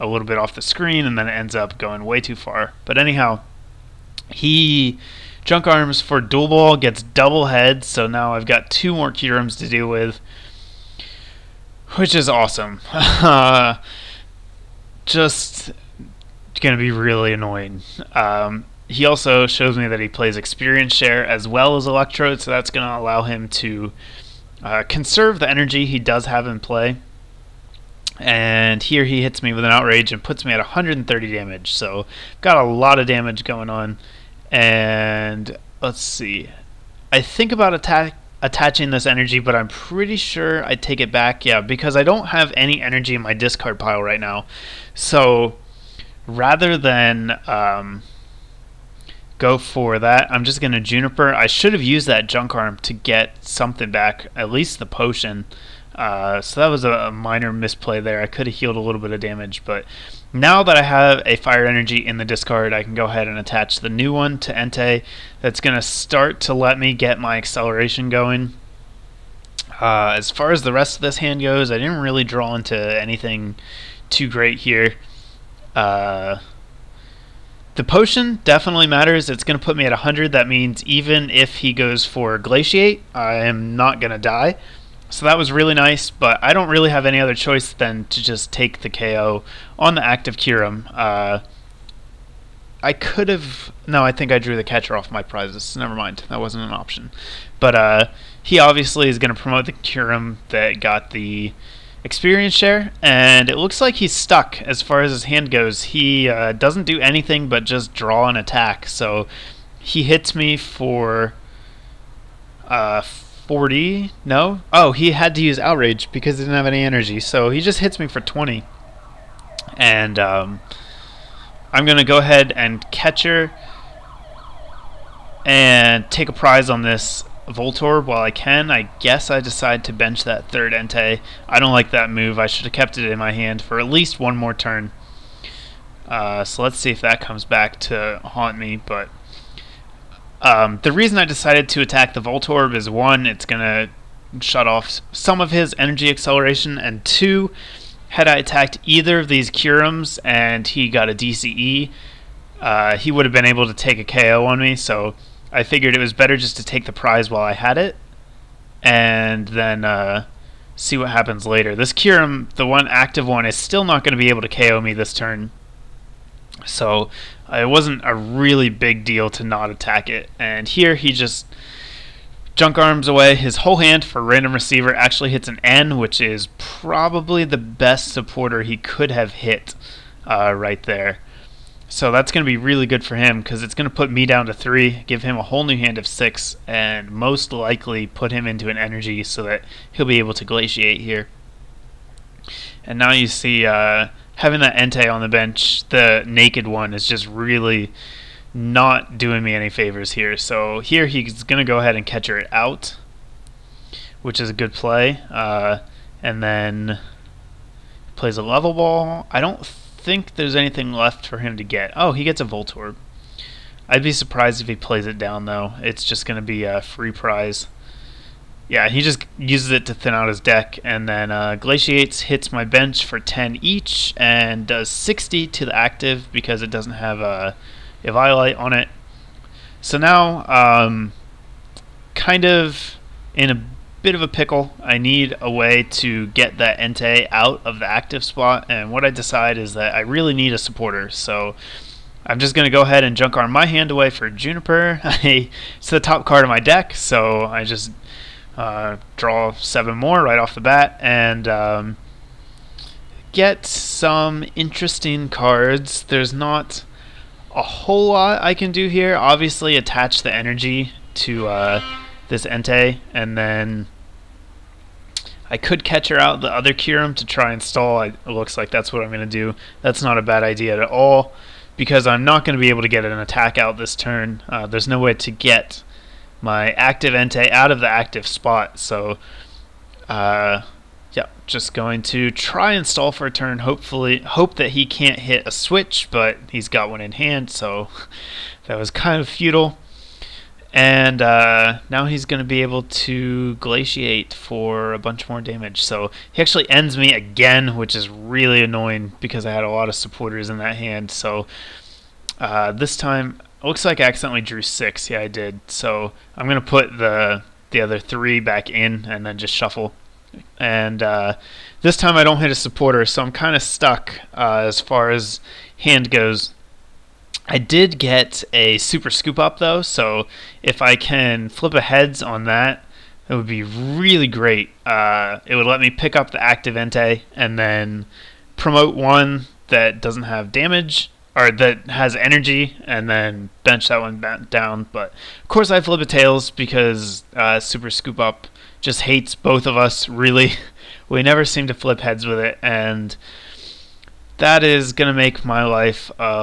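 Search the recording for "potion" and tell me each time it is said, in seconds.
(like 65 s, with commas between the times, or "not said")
54 s, 77 s.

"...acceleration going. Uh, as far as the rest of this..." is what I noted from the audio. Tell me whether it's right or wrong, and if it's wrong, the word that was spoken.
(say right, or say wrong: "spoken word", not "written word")
right.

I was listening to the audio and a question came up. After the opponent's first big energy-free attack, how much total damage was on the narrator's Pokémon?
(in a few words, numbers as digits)
130.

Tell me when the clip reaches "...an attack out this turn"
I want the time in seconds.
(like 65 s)
273 s.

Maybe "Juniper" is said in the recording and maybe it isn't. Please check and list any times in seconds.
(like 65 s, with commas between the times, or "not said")
50 s, 244 s.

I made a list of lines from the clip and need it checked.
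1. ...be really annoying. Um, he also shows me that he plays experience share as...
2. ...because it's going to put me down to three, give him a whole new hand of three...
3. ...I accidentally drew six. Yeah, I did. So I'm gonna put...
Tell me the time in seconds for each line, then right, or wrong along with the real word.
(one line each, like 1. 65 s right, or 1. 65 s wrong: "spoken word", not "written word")
1. 16 s right
2. 183 s wrong: "six", not "three"
3. 303 s right.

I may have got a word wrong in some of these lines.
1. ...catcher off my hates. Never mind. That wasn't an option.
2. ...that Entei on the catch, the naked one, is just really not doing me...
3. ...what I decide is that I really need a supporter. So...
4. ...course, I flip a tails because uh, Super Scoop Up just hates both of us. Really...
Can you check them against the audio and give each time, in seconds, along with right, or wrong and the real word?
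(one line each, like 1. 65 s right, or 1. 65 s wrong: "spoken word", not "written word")
1. 94 s wrong: "prizes", not "hates"
2. 194 s wrong: "bench", not "catch"
3. 238 s right
4. 335 s right.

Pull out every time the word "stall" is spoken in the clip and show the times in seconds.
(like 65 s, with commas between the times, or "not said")
267 s, 282 s.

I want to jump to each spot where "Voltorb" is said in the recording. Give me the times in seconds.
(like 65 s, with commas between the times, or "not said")
127 s, 142 s, 212 s.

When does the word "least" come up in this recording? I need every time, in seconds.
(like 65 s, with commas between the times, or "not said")
54 s, 133 s.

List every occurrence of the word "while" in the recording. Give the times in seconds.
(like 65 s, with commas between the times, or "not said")
128 s, 157 s.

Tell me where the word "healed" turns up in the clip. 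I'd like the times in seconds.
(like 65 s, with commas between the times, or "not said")
58 s.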